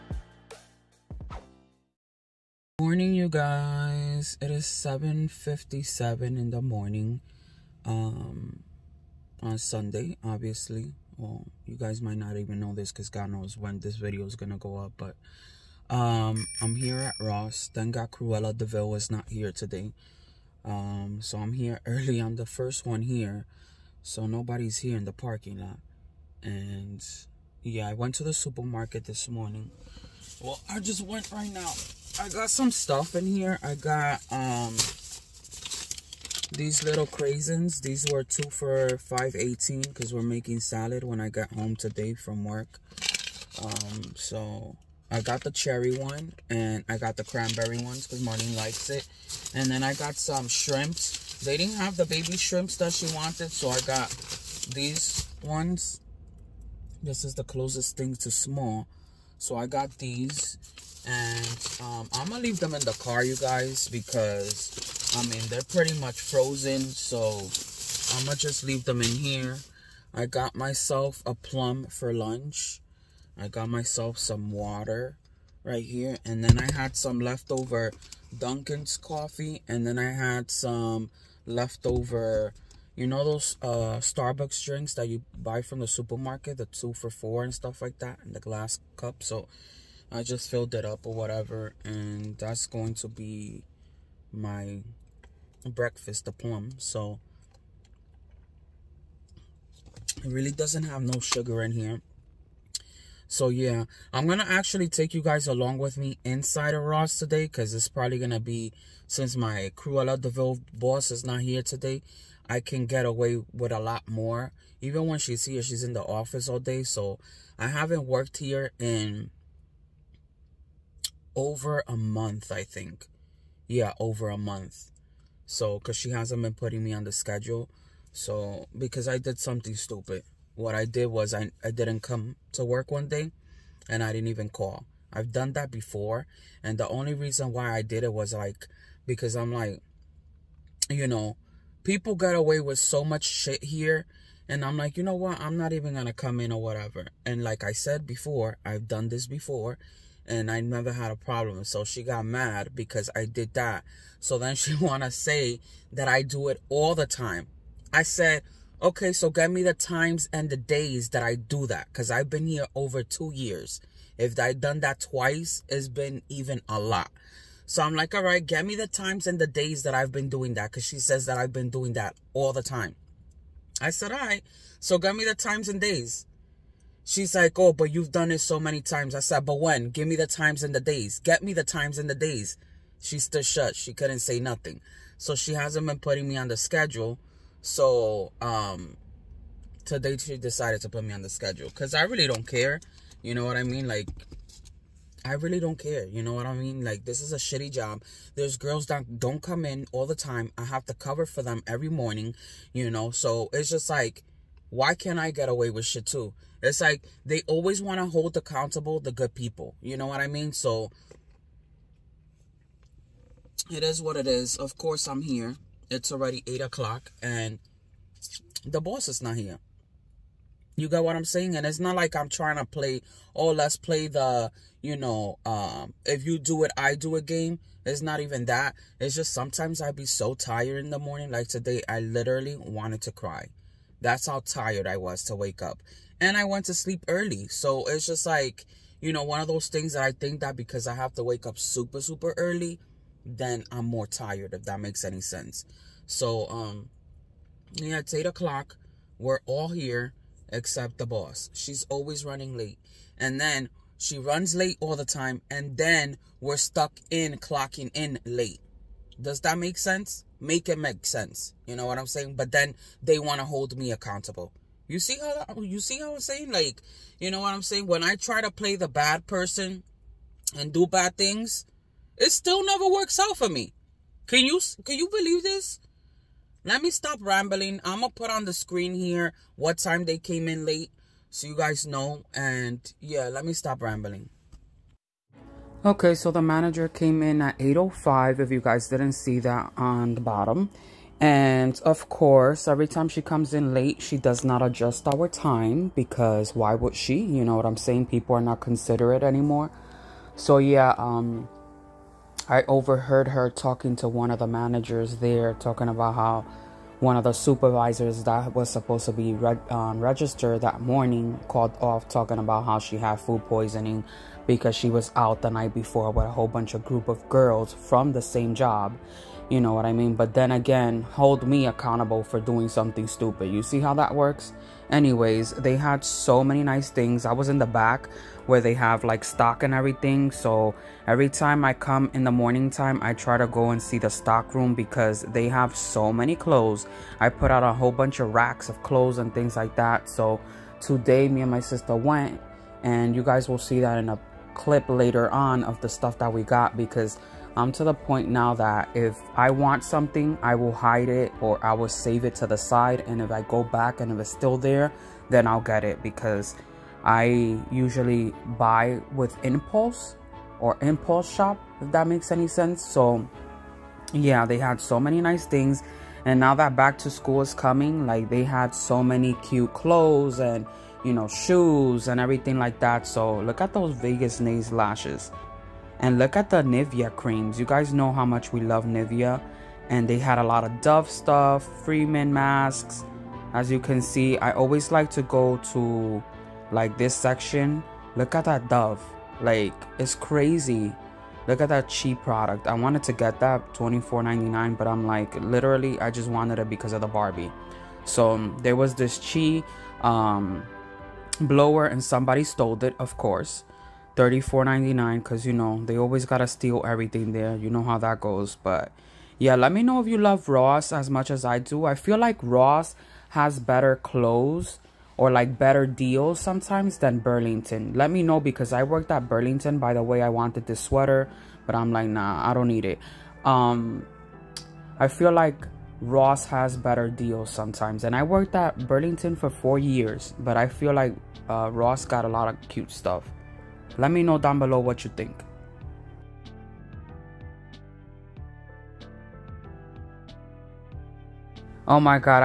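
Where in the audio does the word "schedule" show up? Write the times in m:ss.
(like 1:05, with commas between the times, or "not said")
2:07, 3:06, 3:11.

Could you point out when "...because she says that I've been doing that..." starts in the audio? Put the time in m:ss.
2:50.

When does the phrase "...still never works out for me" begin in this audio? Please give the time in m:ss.
4:32.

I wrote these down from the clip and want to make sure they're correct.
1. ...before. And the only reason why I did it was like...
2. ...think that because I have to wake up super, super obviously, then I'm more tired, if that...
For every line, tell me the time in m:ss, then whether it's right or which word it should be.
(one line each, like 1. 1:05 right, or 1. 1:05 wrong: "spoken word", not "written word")
1. 2:15 right
2. 4:00 wrong: "early", not "obviously".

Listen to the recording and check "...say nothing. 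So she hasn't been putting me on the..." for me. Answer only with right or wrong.
right.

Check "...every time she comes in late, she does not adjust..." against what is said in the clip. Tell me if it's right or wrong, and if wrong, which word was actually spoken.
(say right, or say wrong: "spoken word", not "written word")
right.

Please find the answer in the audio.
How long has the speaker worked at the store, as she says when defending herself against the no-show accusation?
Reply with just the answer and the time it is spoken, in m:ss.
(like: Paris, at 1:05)
over 2 years, at 2:42.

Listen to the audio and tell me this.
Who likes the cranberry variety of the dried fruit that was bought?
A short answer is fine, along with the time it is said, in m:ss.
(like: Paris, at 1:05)
Marlene, at 0:48.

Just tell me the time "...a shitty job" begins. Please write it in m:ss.
3:17.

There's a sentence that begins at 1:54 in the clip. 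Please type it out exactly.
Even when she's here, she's in the office all day, so I haven't worked here in over a month, I think.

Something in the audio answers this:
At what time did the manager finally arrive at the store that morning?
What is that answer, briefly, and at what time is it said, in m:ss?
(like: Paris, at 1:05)
8:05, at 4:47.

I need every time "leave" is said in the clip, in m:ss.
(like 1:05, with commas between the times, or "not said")
1:02, 1:08.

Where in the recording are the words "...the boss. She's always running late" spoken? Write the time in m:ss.
4:10.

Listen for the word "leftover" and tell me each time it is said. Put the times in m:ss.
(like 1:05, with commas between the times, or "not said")
1:17, 1:21.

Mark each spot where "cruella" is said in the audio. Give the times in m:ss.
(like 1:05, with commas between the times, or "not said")
0:18, 1:49.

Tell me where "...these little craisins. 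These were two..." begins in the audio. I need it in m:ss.
0:36.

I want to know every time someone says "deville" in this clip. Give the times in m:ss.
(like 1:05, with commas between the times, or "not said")
0:18, 1:50.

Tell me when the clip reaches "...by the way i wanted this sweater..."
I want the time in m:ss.
6:59.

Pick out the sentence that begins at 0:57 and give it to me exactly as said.
This is the closest thing to small.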